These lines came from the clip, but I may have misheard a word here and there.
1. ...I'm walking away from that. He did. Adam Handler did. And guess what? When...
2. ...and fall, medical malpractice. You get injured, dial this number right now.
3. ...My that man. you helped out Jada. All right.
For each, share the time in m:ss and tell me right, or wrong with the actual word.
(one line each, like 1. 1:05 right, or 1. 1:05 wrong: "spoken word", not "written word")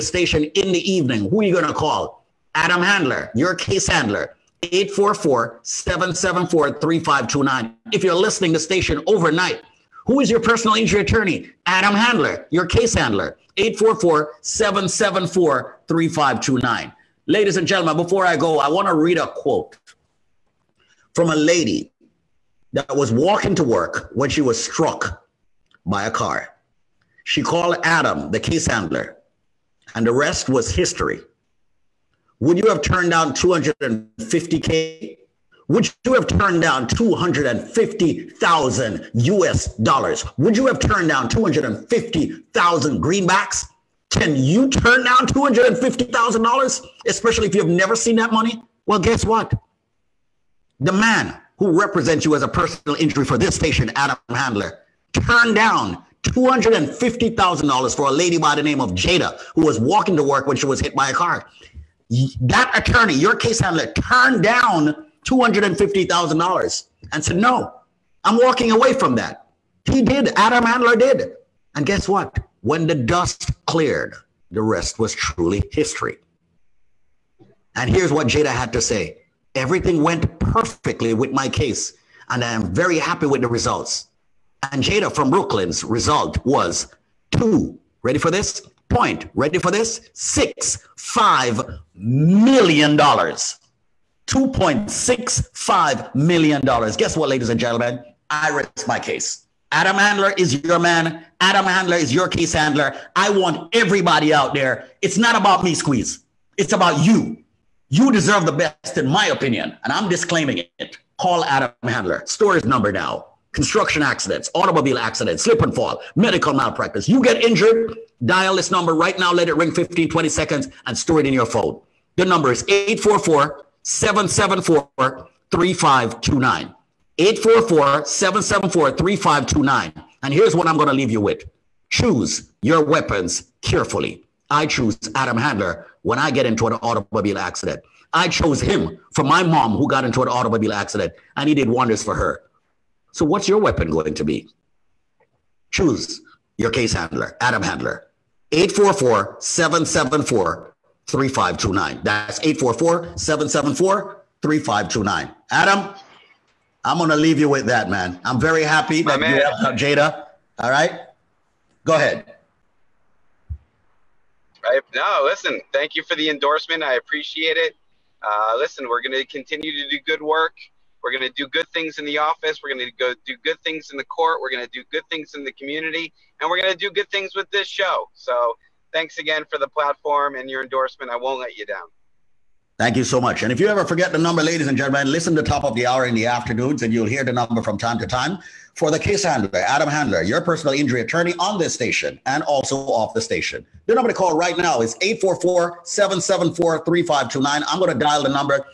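1. 1:08 right
2. 1:55 right
3. 2:39 right.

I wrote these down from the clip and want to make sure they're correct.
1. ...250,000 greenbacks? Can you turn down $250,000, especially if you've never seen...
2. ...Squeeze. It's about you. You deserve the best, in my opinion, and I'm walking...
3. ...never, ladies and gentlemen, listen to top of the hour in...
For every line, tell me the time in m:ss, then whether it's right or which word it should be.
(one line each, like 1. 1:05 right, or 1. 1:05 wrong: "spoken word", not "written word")
1. 0:41 right
2. 1:45 wrong: "disclaiming", not "walking"
3. 3:04 wrong: "number", not "never".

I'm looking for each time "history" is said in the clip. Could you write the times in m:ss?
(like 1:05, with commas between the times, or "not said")
0:30, 1:15.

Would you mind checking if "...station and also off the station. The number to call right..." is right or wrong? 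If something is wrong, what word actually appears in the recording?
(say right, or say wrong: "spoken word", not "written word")
right.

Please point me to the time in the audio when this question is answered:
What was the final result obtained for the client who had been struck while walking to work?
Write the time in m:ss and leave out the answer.
1:34.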